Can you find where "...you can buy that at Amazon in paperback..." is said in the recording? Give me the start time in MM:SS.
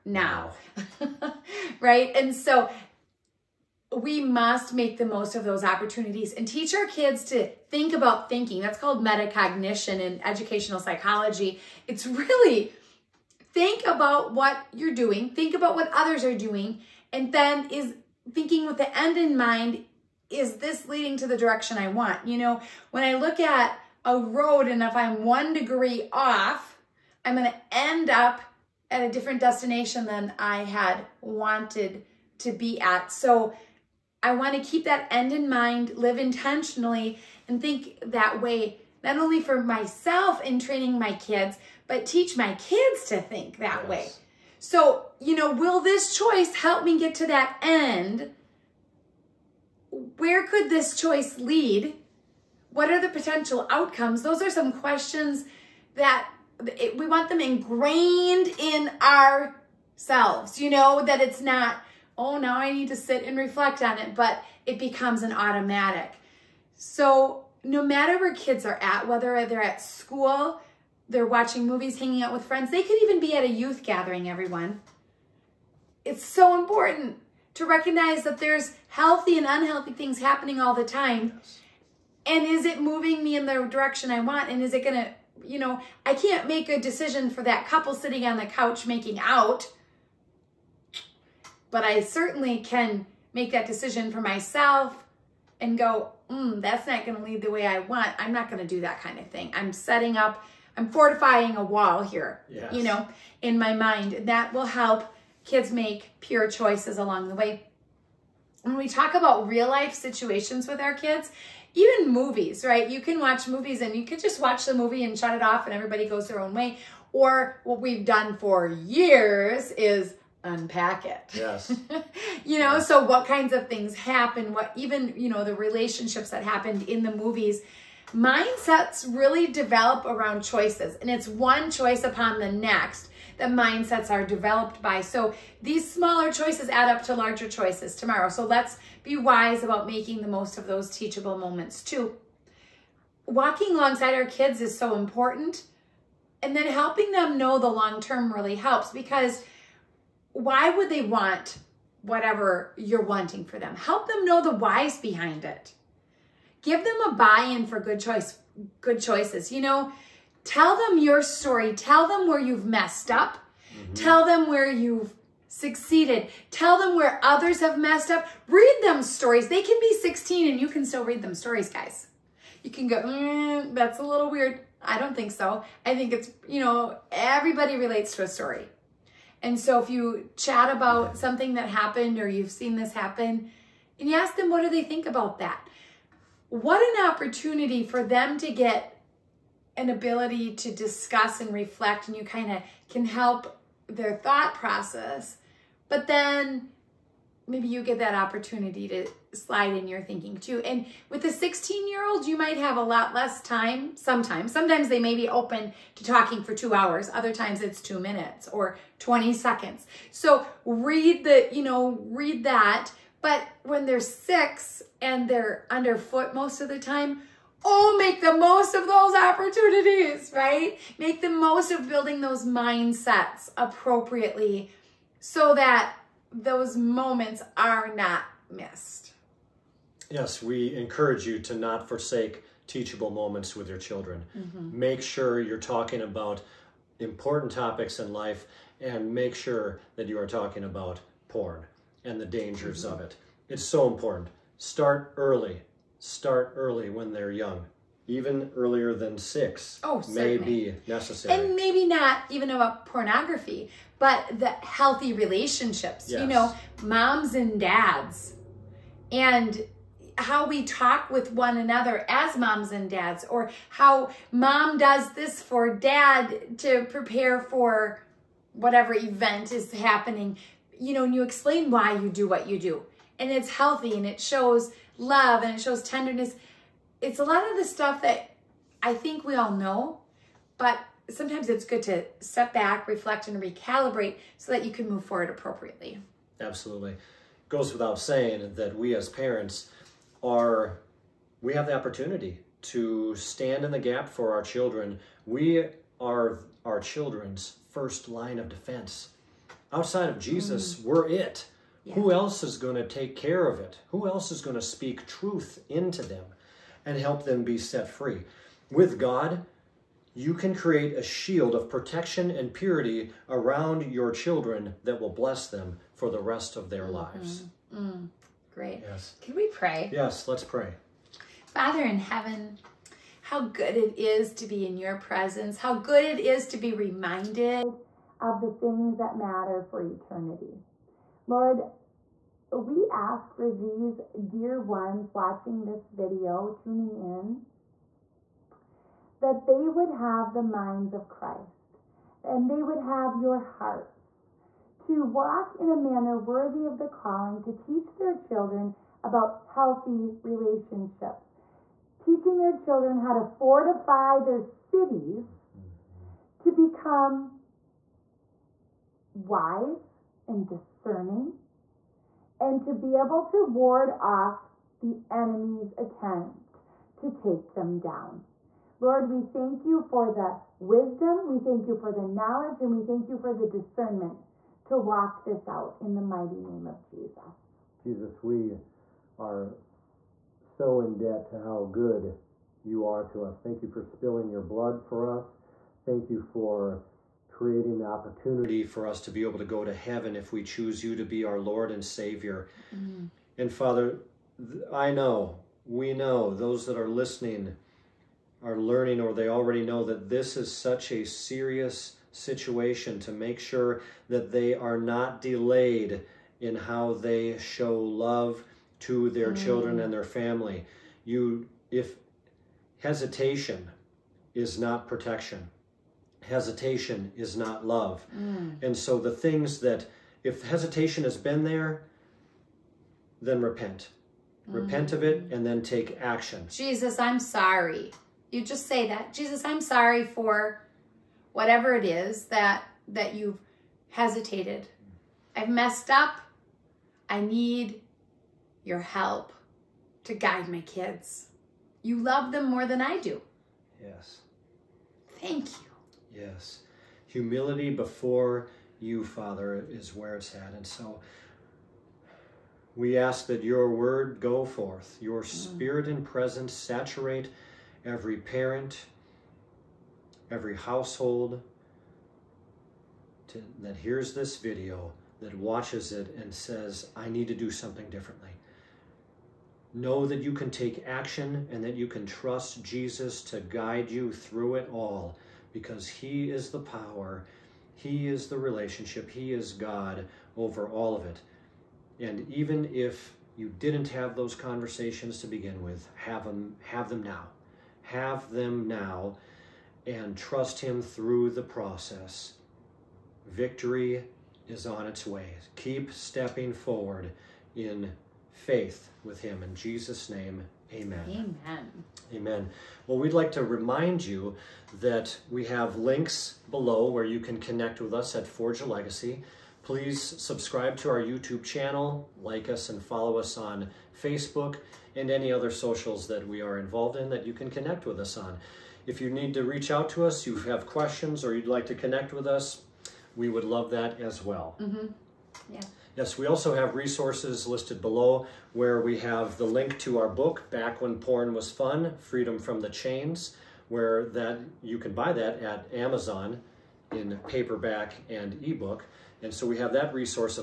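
08:54.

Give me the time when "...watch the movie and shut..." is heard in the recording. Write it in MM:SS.
01:54.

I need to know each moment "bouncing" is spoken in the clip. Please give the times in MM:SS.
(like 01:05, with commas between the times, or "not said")
not said.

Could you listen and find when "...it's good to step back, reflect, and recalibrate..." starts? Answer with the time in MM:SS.
04:41.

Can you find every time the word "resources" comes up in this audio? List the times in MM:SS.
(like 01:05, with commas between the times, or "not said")
08:46.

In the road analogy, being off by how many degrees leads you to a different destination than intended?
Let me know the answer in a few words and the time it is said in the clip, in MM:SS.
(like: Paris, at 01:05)
1, at 00:25.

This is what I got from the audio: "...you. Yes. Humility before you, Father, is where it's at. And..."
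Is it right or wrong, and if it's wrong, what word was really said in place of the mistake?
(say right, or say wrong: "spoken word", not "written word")
right.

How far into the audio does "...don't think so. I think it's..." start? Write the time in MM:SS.
02:54.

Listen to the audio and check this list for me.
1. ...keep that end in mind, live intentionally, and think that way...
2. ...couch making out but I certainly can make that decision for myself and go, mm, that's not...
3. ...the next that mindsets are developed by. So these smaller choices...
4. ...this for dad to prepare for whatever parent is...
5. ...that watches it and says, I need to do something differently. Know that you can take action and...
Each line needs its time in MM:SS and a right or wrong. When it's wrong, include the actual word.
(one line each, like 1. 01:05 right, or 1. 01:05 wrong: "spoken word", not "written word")
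1. 00:34 right
2. 01:28 right
3. 02:12 right
4. 04:25 wrong: "event", not "parent"
5. 07:45 right.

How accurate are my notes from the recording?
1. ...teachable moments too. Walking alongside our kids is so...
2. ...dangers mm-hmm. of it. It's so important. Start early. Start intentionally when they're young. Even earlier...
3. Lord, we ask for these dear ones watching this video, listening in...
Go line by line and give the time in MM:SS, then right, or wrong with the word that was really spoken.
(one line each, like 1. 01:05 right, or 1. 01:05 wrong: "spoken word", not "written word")
1. 02:20 right
2. 04:02 wrong: "early", not "intentionally"
3. 05:31 wrong: "tuning", not "listening".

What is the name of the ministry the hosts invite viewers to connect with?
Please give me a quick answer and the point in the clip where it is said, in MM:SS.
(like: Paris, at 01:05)
Forge a Legacy, at 08:28.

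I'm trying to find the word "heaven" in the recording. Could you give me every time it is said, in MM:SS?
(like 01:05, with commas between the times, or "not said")
05:21, 06:29.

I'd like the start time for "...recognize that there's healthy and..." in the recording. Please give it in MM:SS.
01:17.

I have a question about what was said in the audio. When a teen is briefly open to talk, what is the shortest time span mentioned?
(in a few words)
20 seconds.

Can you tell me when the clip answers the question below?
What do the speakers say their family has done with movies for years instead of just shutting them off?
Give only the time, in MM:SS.
02:00.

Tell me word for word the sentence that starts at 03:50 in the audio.
Yes, we encourage you to not forsake teachable moments with your children.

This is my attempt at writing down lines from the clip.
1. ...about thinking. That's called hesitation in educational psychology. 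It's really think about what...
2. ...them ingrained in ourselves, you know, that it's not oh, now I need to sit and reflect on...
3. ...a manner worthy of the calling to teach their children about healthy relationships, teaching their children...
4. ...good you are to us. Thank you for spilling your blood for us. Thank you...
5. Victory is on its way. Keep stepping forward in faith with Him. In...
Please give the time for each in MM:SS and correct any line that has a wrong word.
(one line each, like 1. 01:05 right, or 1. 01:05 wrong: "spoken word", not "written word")
1. 00:07 wrong: "metacognition", not "hesitation"
2. 00:57 right
3. 05:45 right
4. 06:21 right
5. 08:13 right.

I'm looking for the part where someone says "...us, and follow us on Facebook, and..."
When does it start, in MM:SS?
08:32.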